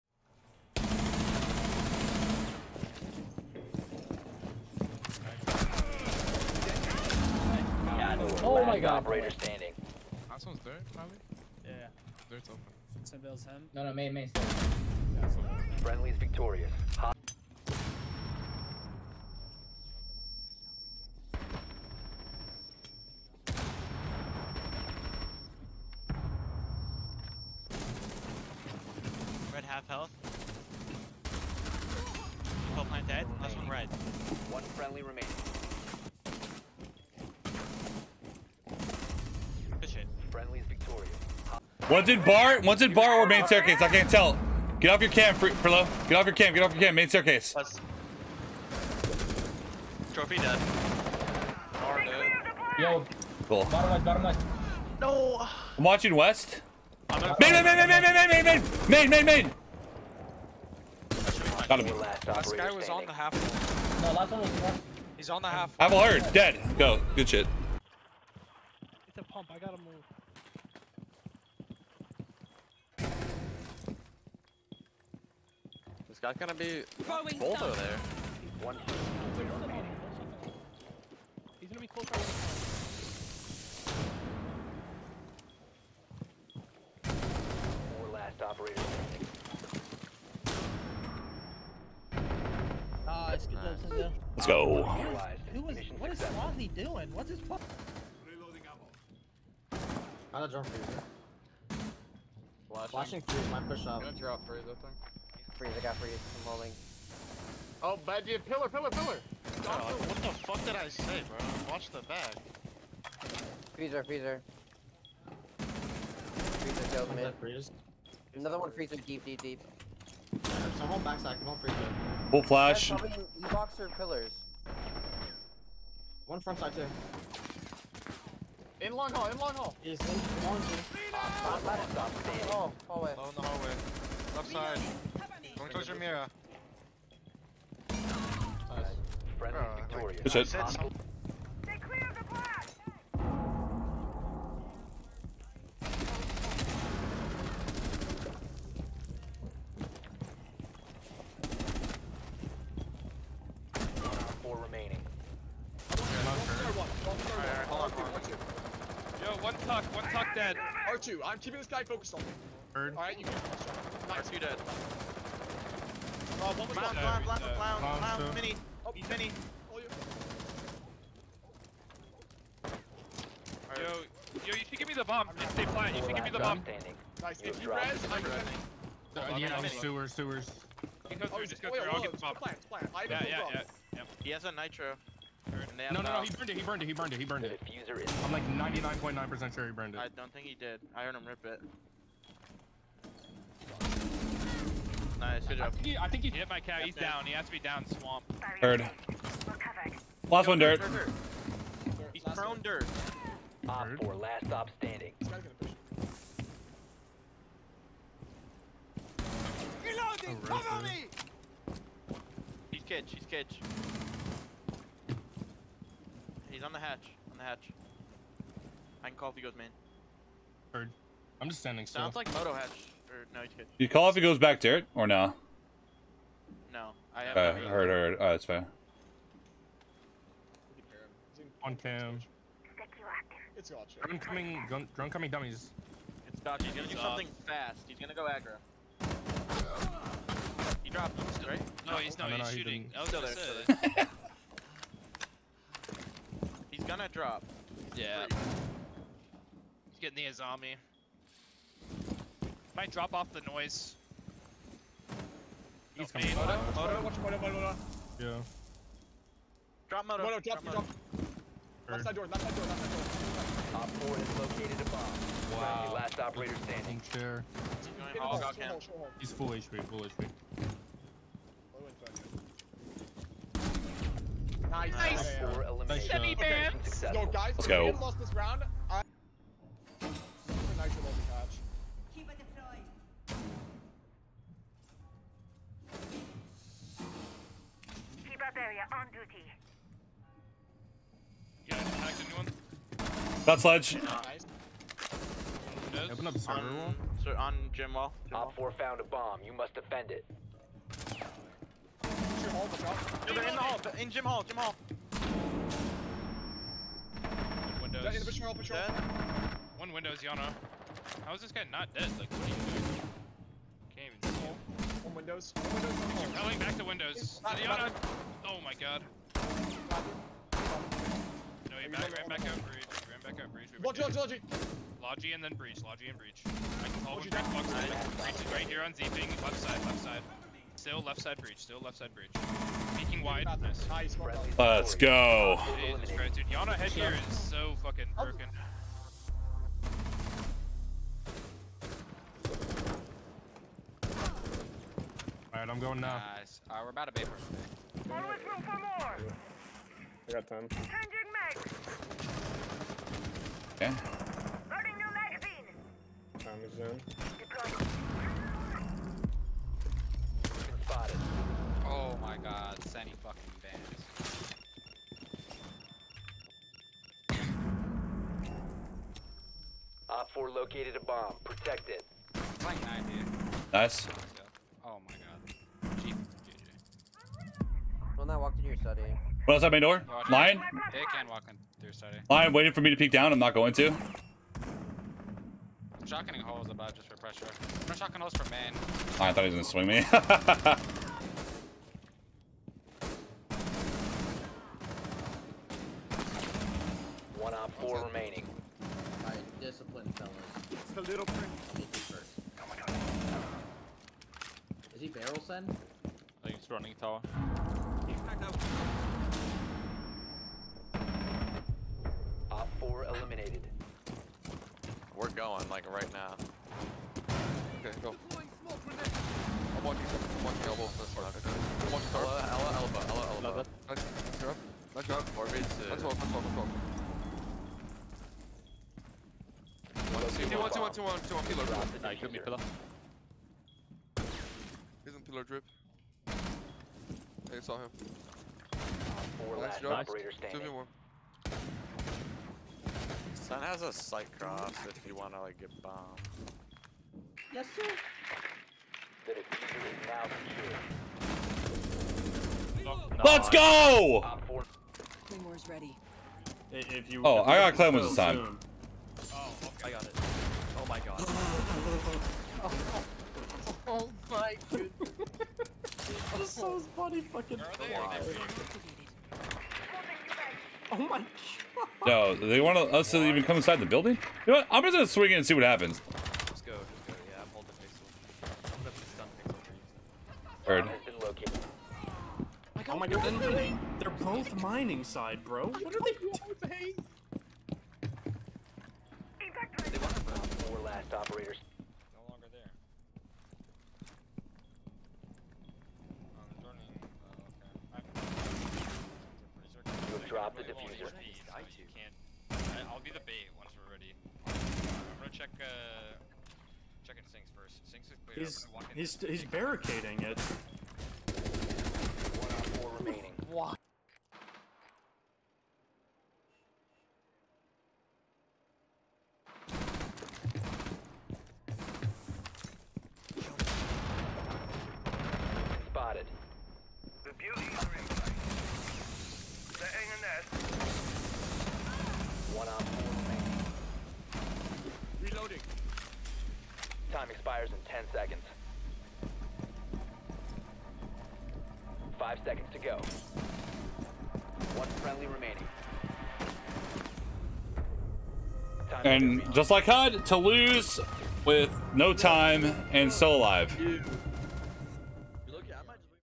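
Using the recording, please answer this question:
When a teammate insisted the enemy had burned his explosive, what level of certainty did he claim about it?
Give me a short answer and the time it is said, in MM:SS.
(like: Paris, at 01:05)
99.9%, at 03:08.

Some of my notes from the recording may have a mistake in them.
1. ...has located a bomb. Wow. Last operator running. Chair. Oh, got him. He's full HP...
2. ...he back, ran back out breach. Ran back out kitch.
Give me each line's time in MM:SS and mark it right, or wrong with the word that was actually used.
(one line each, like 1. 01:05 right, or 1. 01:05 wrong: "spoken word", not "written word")
1. 04:24 wrong: "standing", not "running"
2. 05:21 wrong: "breach", not "kitch".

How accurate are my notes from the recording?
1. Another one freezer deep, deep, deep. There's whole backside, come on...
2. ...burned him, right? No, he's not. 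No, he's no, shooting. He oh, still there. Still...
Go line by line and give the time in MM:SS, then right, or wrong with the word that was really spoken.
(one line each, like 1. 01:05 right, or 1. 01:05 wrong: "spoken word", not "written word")
1. 01:58 right
2. 04:00 wrong: "dropped", not "burned".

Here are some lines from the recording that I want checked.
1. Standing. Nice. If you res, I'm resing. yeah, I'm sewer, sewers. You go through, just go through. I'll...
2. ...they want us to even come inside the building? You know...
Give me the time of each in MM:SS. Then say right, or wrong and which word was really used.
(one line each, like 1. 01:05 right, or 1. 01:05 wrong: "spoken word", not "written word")
1. 02:56 right
2. 07:52 right.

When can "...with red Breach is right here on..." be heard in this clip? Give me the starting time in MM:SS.
05:27.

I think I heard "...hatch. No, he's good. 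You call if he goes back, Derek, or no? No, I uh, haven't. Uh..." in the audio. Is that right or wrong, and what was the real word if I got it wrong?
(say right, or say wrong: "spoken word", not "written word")
right.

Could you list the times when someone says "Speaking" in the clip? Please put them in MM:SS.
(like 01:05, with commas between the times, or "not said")
05:32.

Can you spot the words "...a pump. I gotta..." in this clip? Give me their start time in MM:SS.
01:09.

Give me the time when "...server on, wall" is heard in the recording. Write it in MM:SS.
04:56.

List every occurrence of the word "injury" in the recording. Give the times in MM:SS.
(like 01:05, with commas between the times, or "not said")
not said.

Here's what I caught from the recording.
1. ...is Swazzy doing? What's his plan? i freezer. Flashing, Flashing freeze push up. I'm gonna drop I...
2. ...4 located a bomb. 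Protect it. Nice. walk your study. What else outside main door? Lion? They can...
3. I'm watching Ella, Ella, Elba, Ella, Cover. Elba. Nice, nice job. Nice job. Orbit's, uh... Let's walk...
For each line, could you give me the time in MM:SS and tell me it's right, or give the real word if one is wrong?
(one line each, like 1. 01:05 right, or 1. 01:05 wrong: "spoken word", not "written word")
1. 01:36 right
2. 06:10 right
3. 07:01 wrong: "Elba", not "Cover".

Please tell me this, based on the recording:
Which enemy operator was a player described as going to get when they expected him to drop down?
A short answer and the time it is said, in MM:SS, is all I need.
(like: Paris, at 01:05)
Azami, at 04:10.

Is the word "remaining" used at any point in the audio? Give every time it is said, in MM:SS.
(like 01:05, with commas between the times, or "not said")
00:35, 06:38, 08:32, 09:05.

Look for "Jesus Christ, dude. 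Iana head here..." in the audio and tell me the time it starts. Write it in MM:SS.
05:35.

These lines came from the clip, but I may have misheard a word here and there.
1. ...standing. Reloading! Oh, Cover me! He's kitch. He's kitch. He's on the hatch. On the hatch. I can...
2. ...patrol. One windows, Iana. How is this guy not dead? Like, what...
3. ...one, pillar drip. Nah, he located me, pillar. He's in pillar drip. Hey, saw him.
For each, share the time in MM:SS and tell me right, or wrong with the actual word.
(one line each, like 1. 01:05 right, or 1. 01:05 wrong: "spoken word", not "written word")
1. 03:24 right
2. 05:08 right
3. 07:11 wrong: "killed", not "located".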